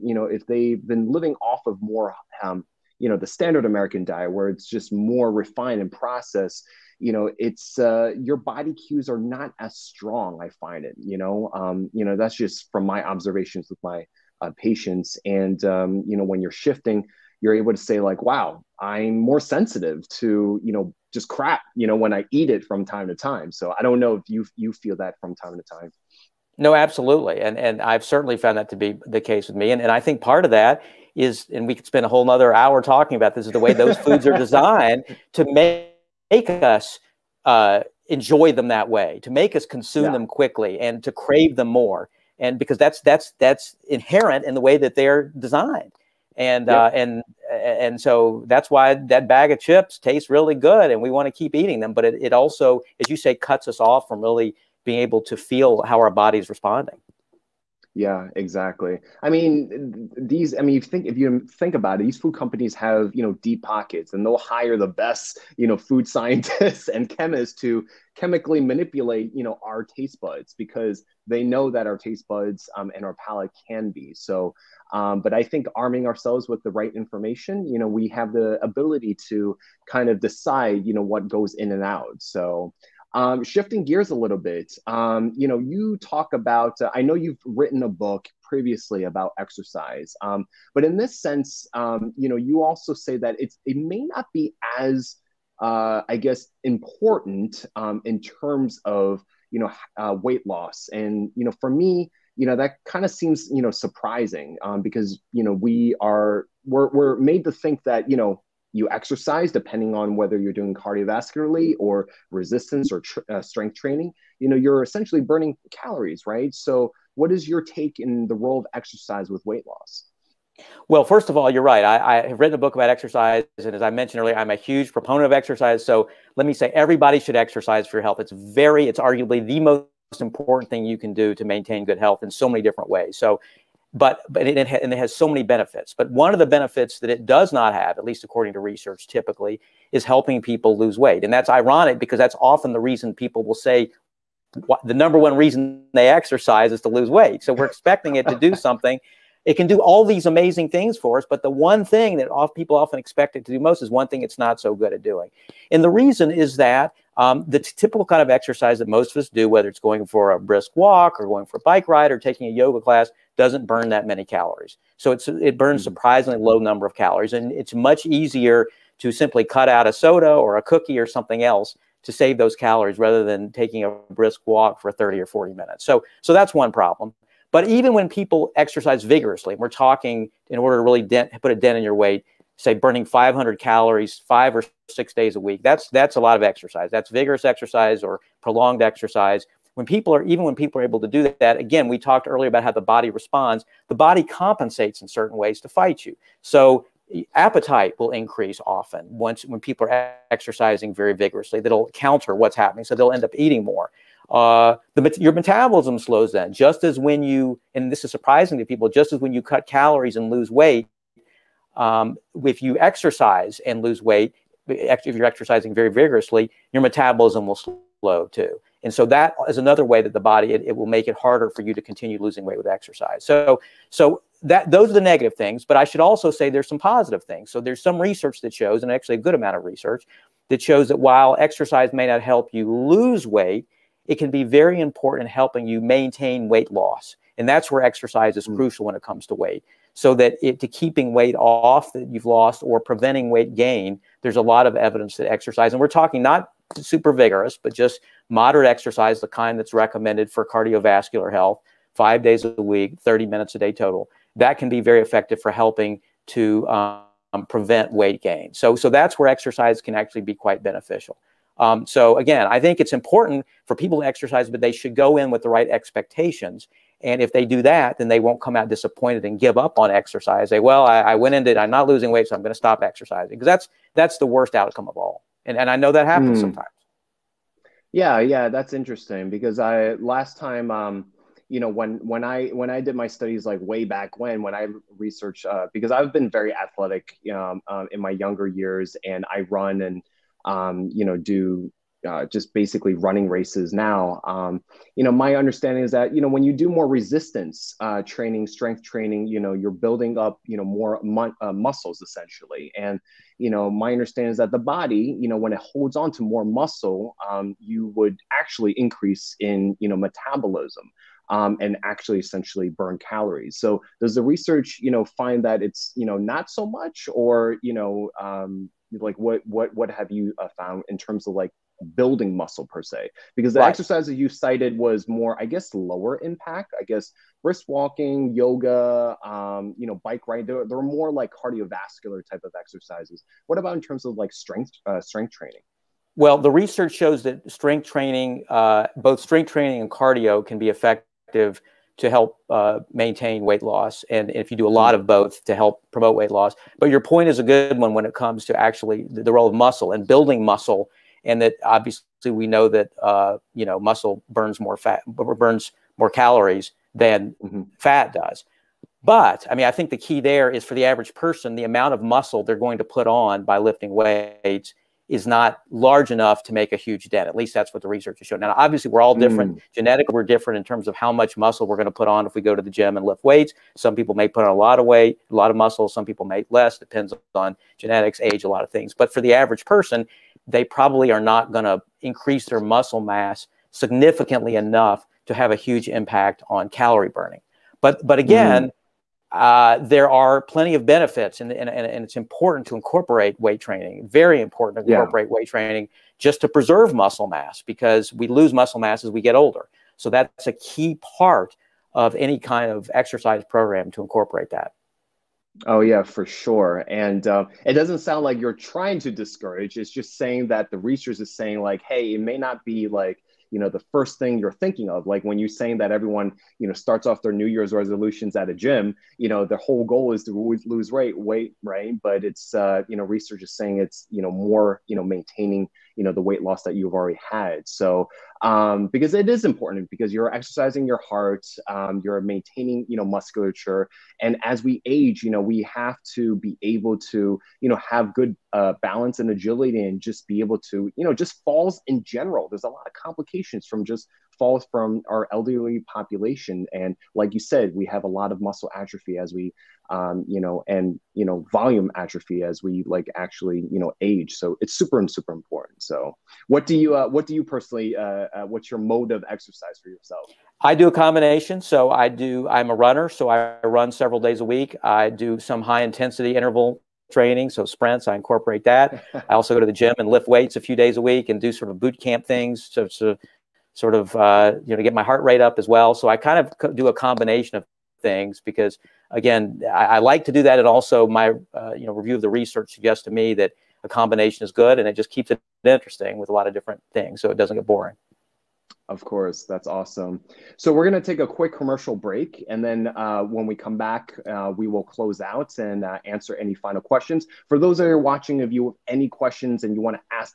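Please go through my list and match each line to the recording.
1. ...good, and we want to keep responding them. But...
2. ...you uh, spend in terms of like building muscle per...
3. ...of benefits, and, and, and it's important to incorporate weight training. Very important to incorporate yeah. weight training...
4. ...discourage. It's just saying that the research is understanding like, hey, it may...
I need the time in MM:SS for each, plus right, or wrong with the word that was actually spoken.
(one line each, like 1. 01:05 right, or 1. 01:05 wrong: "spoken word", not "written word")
1. 00:50 wrong: "eating", not "responding"
2. 05:20 wrong: "found", not "spend"
3. 06:30 right
4. 06:49 wrong: "saying", not "understanding".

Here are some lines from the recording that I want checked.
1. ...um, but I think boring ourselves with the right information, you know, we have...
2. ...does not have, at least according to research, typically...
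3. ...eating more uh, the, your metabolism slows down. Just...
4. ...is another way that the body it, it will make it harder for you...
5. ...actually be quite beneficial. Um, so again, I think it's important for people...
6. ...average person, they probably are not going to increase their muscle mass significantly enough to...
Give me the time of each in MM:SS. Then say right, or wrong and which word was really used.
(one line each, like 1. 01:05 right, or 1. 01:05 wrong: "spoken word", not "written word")
1. 01:14 wrong: "arming", not "boring"
2. 02:17 right
3. 03:23 right
4. 03:39 right
5. 04:19 right
6. 06:19 right.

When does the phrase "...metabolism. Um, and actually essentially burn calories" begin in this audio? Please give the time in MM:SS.
05:09.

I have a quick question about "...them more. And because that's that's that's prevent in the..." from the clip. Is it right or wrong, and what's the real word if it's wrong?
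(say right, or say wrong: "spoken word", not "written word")
wrong: "inherent", not "prevent".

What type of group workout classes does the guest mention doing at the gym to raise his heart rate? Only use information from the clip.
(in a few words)
boot camp.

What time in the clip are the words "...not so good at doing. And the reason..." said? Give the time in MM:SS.
02:34.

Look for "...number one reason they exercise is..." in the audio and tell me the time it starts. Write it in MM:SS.
02:24.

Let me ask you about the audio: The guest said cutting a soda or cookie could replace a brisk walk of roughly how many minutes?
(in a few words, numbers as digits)
30 or 40 minutes.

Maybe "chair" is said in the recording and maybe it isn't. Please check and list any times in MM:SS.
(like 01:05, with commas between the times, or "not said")
not said.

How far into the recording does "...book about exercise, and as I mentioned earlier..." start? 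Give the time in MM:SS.
02:02.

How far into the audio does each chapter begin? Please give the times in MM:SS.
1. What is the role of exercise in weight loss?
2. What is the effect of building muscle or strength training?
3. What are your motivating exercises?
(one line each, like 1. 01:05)
1. 01:56
2. 05:13
3. 07:36.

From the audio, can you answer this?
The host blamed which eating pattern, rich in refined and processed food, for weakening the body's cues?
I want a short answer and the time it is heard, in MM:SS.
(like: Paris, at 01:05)
standard american diet, at 00:03.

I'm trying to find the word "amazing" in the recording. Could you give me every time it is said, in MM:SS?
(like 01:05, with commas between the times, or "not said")
02:30.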